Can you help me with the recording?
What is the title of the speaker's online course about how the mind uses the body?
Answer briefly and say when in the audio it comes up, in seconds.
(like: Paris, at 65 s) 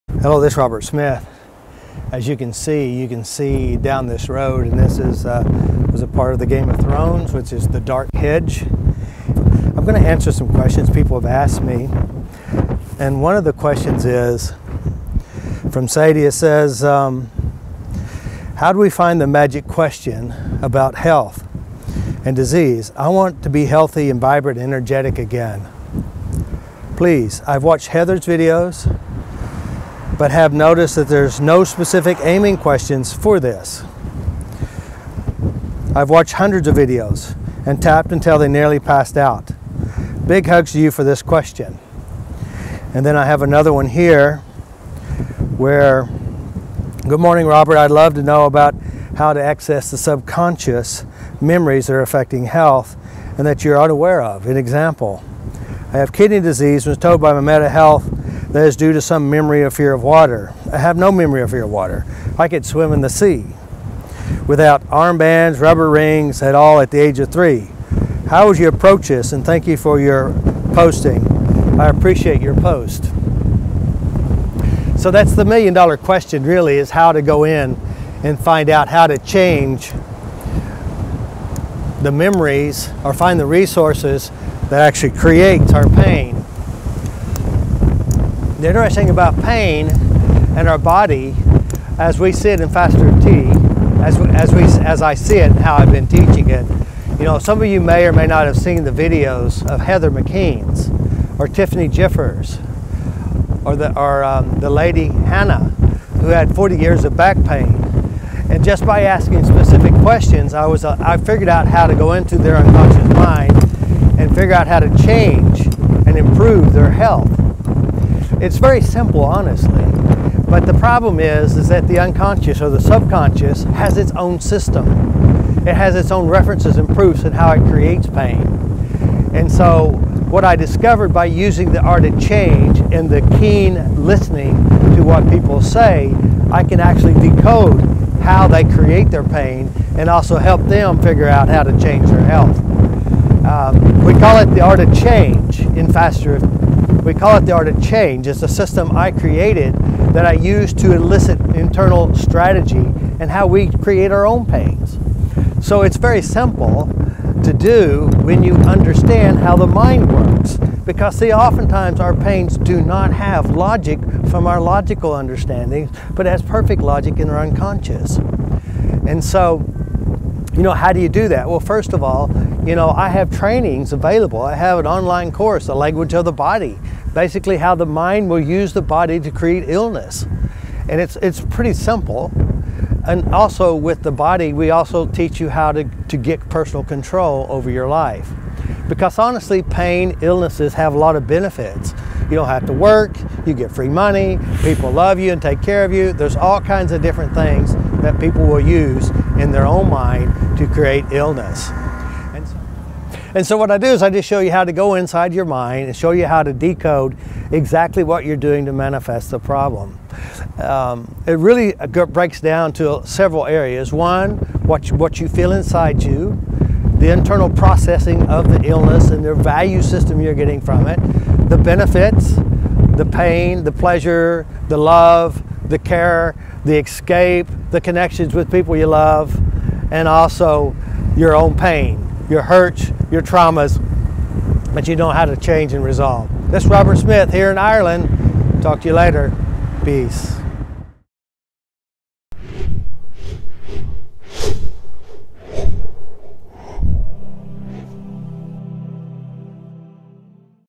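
The Language of the Body, at 175 s.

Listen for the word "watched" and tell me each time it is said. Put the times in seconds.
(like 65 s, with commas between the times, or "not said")
27 s, 36 s.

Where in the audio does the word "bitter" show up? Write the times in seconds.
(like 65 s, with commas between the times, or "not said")
not said.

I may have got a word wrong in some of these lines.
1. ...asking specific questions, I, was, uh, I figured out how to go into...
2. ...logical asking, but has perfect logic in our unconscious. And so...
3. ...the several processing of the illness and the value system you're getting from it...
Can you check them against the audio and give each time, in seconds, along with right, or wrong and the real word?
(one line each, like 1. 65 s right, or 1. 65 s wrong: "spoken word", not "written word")
1. 109 s right
2. 164 s wrong: "understanding", not "asking"
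3. 216 s wrong: "internal", not "several".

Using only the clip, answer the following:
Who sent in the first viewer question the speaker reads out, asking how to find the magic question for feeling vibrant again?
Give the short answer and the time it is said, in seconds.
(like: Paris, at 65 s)
Sadie, at 15 s.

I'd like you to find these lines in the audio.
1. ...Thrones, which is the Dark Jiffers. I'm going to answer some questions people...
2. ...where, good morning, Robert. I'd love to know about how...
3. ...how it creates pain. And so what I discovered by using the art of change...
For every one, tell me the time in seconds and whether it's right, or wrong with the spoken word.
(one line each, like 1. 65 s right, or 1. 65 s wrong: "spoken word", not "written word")
1. 6 s wrong: "Hedge", not "Jiffers"
2. 45 s right
3. 127 s right.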